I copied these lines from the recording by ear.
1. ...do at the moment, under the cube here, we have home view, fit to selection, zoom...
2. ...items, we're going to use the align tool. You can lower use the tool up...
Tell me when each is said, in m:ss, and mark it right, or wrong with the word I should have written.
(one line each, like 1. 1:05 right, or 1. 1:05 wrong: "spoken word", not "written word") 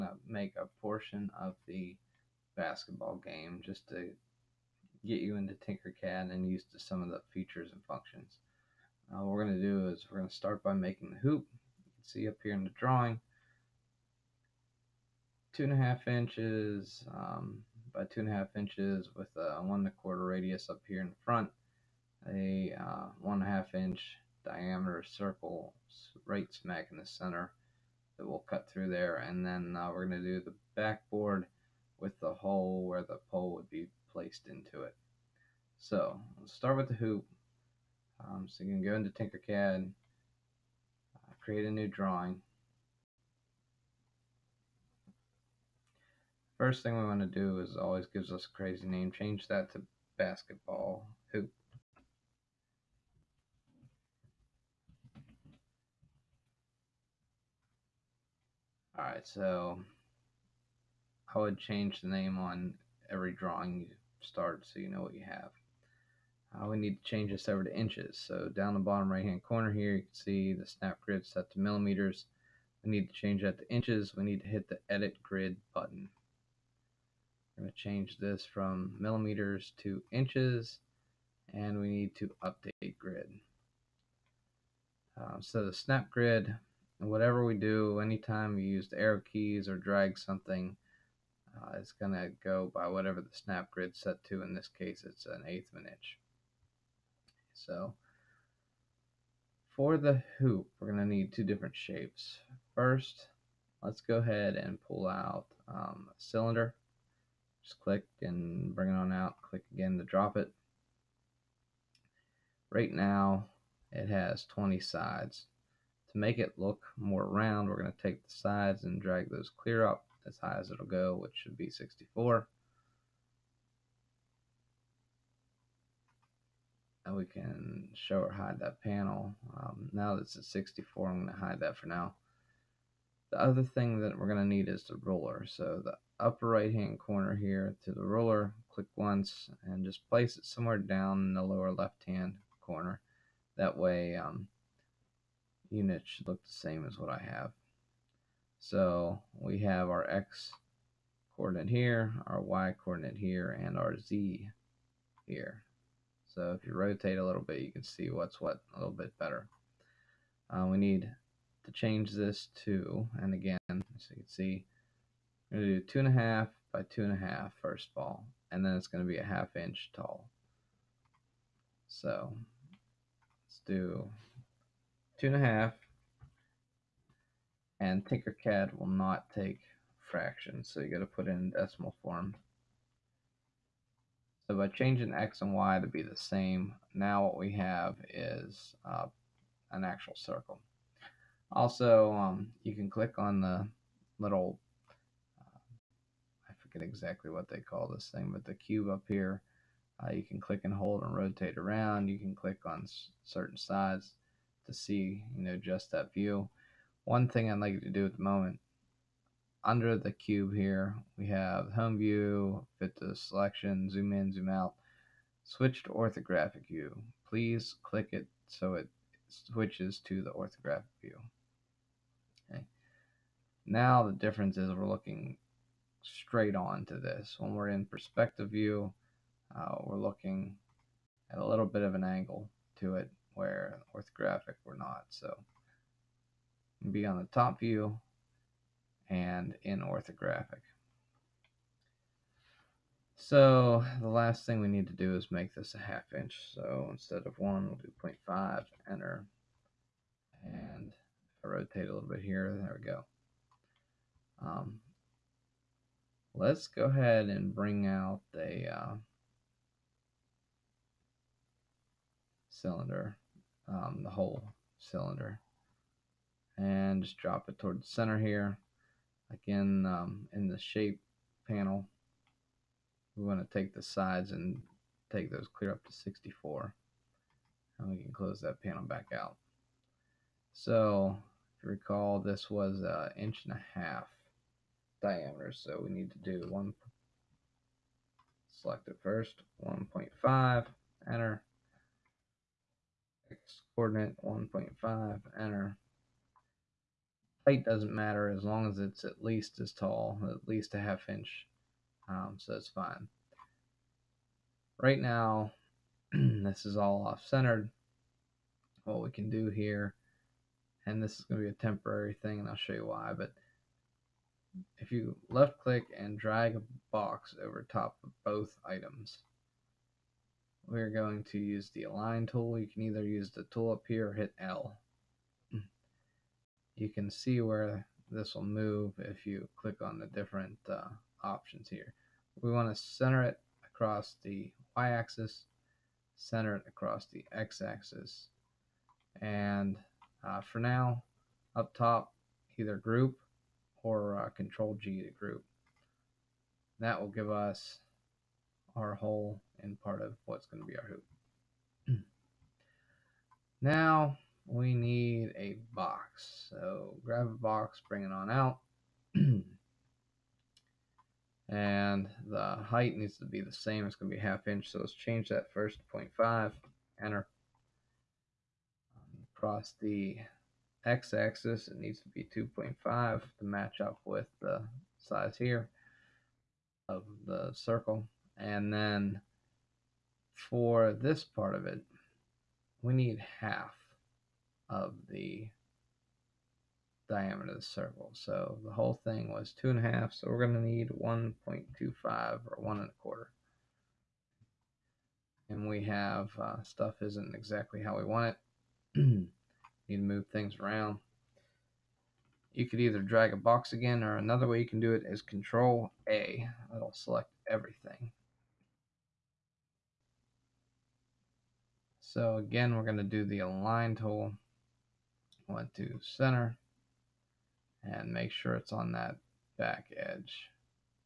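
1. 3:27 right
2. 5:18 wrong: "either", not "lower".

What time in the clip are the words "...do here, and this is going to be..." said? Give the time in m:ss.
5:09.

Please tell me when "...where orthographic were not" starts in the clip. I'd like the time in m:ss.
3:53.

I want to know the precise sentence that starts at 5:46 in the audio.
That will give us our hole and part of what's going to be our hoop.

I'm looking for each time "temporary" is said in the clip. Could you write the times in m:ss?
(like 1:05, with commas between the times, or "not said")
5:11.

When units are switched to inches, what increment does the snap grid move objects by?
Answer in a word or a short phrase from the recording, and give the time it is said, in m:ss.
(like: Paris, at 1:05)
an eighth of an inch, at 1:35.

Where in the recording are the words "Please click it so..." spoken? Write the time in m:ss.
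3:37.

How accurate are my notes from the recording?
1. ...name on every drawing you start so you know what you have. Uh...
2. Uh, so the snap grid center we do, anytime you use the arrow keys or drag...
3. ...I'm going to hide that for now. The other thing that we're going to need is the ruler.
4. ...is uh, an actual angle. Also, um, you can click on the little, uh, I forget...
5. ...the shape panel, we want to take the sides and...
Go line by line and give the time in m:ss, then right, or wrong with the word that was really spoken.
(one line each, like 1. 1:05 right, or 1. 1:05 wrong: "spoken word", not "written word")
1. 1:02 right
2. 1:25 wrong: "whatever", not "center"
3. 2:11 right
4. 3:08 wrong: "circle", not "angle"
5. 4:30 right.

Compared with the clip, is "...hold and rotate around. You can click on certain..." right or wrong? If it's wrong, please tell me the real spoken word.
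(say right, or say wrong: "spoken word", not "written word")
right.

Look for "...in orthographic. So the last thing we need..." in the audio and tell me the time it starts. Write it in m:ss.
3:59.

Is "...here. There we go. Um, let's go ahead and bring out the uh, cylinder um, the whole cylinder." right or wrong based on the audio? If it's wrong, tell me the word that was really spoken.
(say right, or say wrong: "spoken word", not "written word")
right.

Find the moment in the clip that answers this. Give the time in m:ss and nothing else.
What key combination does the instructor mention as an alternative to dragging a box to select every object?
6:45.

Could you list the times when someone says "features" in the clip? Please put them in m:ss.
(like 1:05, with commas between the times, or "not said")
0:07.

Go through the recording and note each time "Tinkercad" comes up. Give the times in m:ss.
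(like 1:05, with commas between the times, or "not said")
0:05, 0:39, 2:58.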